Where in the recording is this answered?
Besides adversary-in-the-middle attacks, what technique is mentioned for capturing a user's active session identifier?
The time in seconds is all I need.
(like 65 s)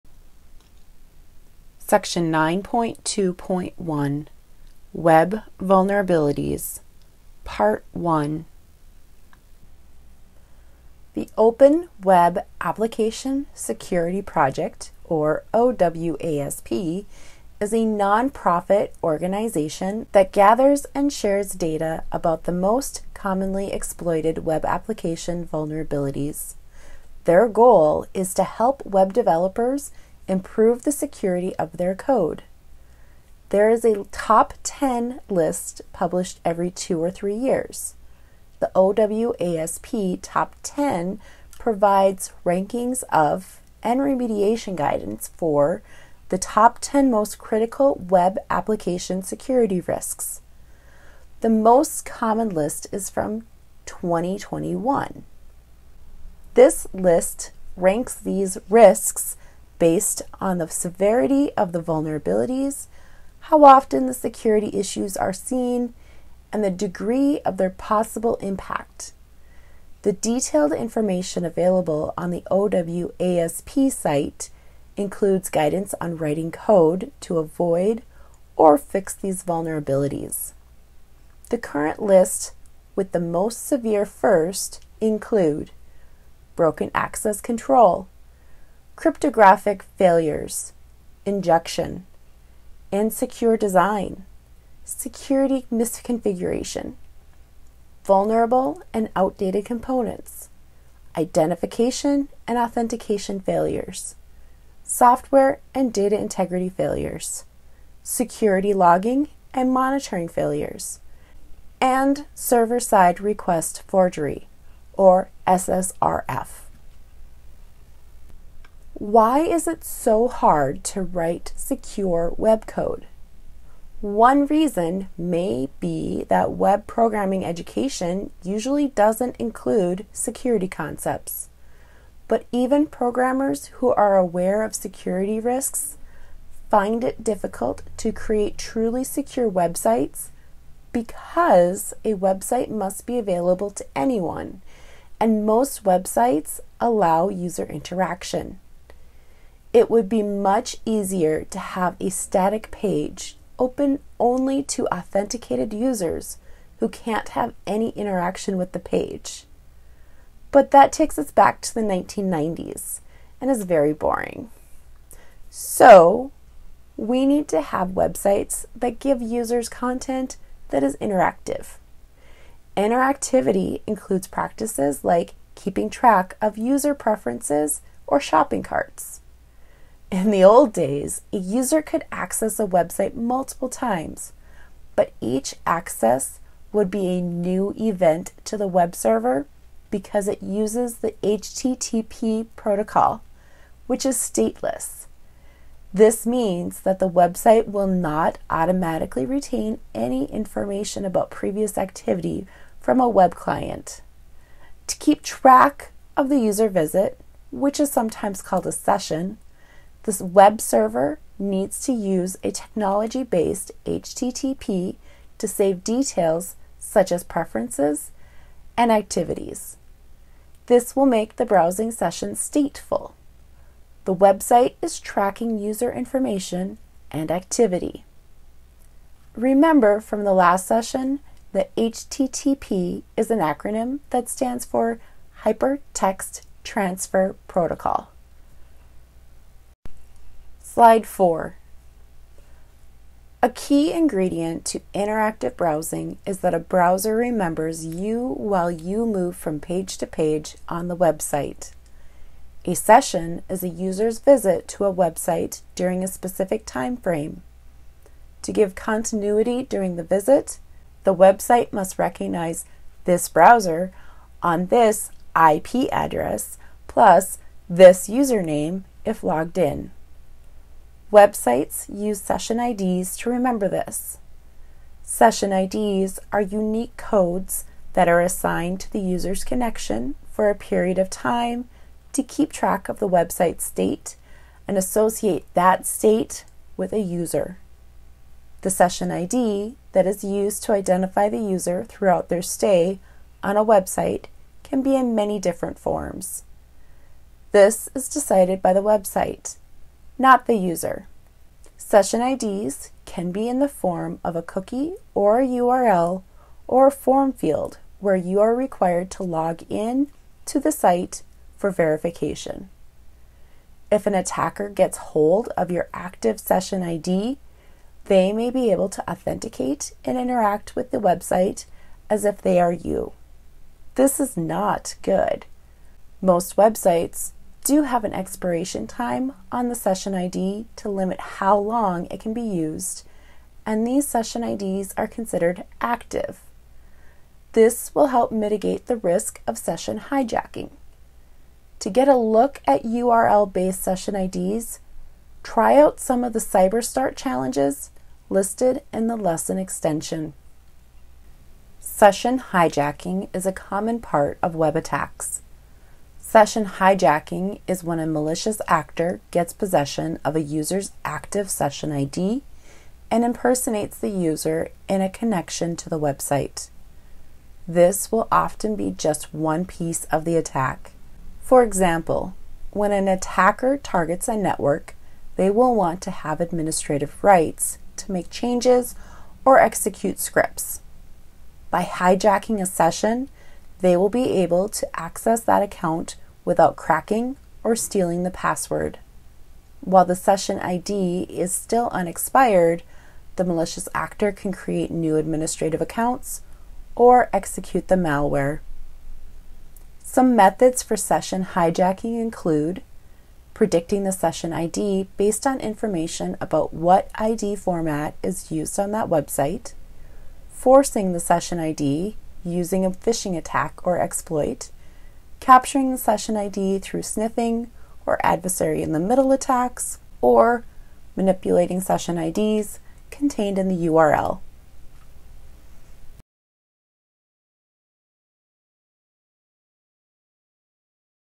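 417 s.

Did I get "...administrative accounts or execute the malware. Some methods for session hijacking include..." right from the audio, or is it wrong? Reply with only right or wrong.
right.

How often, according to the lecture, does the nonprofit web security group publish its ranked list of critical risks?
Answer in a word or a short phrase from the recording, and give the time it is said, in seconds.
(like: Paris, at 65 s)
Every two or three years, at 36 s.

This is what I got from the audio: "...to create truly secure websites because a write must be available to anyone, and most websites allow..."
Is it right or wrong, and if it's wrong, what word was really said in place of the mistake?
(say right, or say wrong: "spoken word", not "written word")
wrong: "website", not "write".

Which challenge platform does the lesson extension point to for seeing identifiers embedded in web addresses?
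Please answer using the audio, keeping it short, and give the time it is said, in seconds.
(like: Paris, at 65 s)
CyberStart, at 346 s.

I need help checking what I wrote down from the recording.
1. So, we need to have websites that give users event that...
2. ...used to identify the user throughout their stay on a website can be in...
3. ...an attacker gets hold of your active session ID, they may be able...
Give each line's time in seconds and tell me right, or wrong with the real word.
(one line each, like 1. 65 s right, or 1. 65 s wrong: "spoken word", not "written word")
1. 165 s wrong: "content", not "event"
2. 290 s right
3. 314 s right.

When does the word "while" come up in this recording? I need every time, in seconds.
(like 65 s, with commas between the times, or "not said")
248 s, 389 s.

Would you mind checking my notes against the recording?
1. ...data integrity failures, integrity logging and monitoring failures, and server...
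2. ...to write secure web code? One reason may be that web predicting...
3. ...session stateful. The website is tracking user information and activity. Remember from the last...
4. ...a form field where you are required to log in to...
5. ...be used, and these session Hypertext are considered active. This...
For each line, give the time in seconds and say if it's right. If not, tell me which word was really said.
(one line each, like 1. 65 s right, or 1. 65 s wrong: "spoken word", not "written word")
1. 105 s wrong: "security", not "integrity"
2. 120 s wrong: "programming", not "predicting"
3. 221 s right
4. 306 s right
5. 332 s wrong: "IDs", not "Hypertext".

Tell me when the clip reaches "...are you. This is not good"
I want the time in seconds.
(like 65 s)
322 s.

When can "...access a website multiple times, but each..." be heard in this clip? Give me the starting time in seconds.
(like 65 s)
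182 s.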